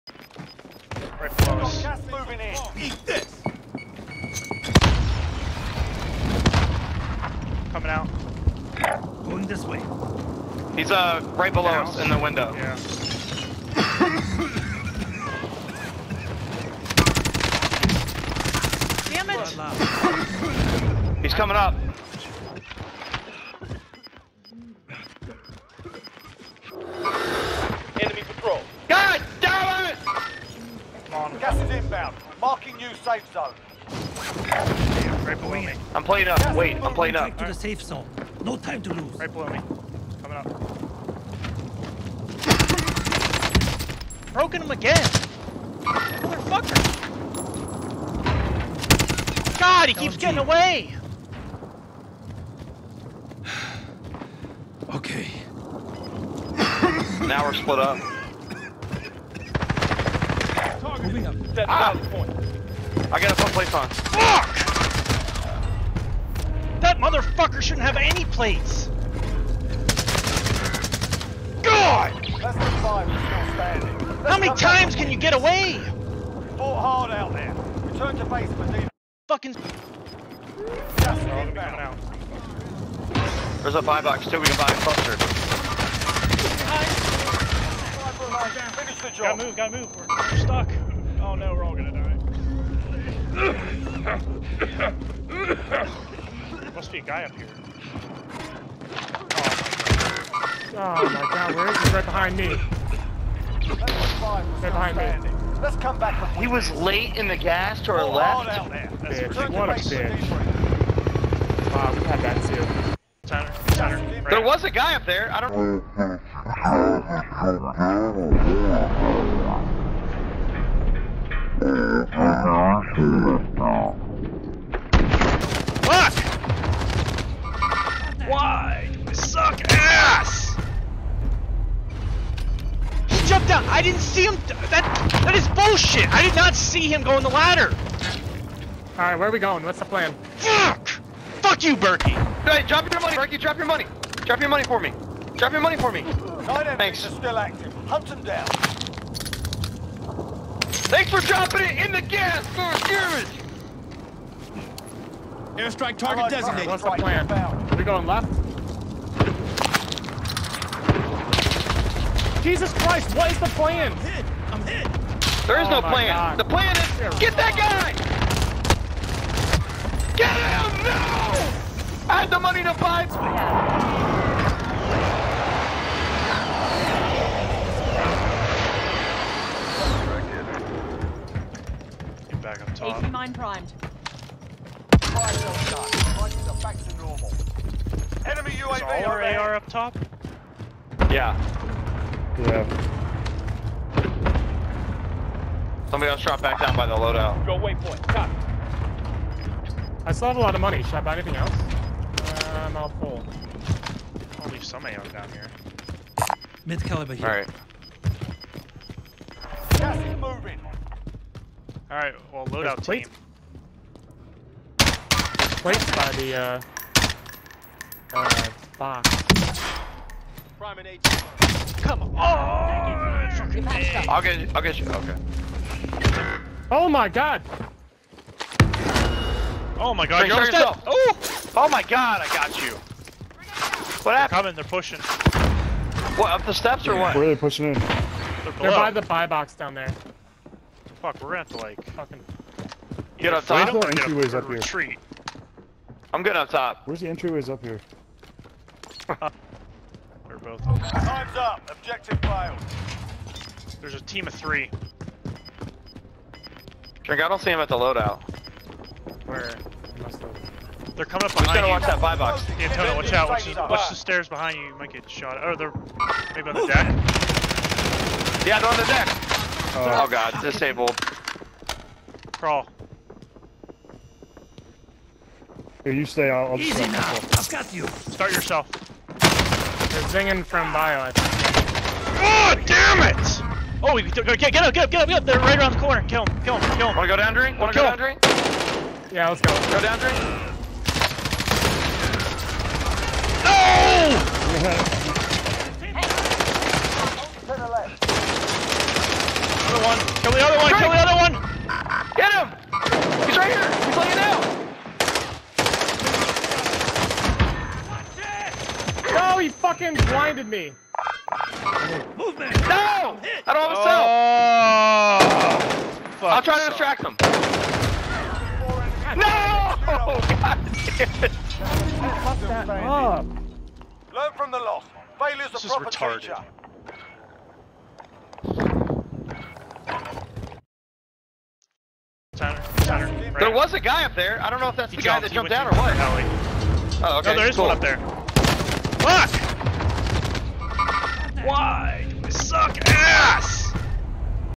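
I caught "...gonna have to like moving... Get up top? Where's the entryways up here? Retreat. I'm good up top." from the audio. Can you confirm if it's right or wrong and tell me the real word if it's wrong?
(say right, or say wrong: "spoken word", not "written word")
wrong: "fucking", not "moving".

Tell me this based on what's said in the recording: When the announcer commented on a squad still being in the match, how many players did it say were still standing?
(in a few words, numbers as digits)
5.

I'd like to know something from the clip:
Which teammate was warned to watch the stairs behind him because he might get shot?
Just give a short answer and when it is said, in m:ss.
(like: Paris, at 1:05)
Antonio, at 4:22.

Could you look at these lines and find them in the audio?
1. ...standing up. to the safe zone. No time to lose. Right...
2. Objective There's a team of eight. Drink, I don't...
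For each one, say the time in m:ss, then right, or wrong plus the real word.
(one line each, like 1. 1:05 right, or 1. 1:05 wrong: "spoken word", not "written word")
1. 0:36 wrong: "playing", not "standing"
2. 4:11 wrong: "three", not "eight".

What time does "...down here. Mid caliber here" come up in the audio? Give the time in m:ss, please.
3:25.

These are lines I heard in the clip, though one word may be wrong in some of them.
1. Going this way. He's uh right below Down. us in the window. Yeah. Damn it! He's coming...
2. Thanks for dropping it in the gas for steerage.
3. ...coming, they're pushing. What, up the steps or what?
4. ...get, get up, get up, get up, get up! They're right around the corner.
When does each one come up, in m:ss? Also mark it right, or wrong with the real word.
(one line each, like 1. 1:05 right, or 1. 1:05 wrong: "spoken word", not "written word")
1. 0:09 right
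2. 2:30 right
3. 3:54 right
4. 4:44 right.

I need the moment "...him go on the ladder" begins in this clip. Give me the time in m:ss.
2:16.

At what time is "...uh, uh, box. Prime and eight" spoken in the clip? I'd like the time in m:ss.
3:36.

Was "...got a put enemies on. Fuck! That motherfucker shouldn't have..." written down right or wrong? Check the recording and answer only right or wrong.
wrong.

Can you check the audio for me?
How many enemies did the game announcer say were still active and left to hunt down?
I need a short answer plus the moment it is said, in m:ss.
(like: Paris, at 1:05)
9, at 2:26.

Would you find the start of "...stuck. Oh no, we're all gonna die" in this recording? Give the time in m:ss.
1:30.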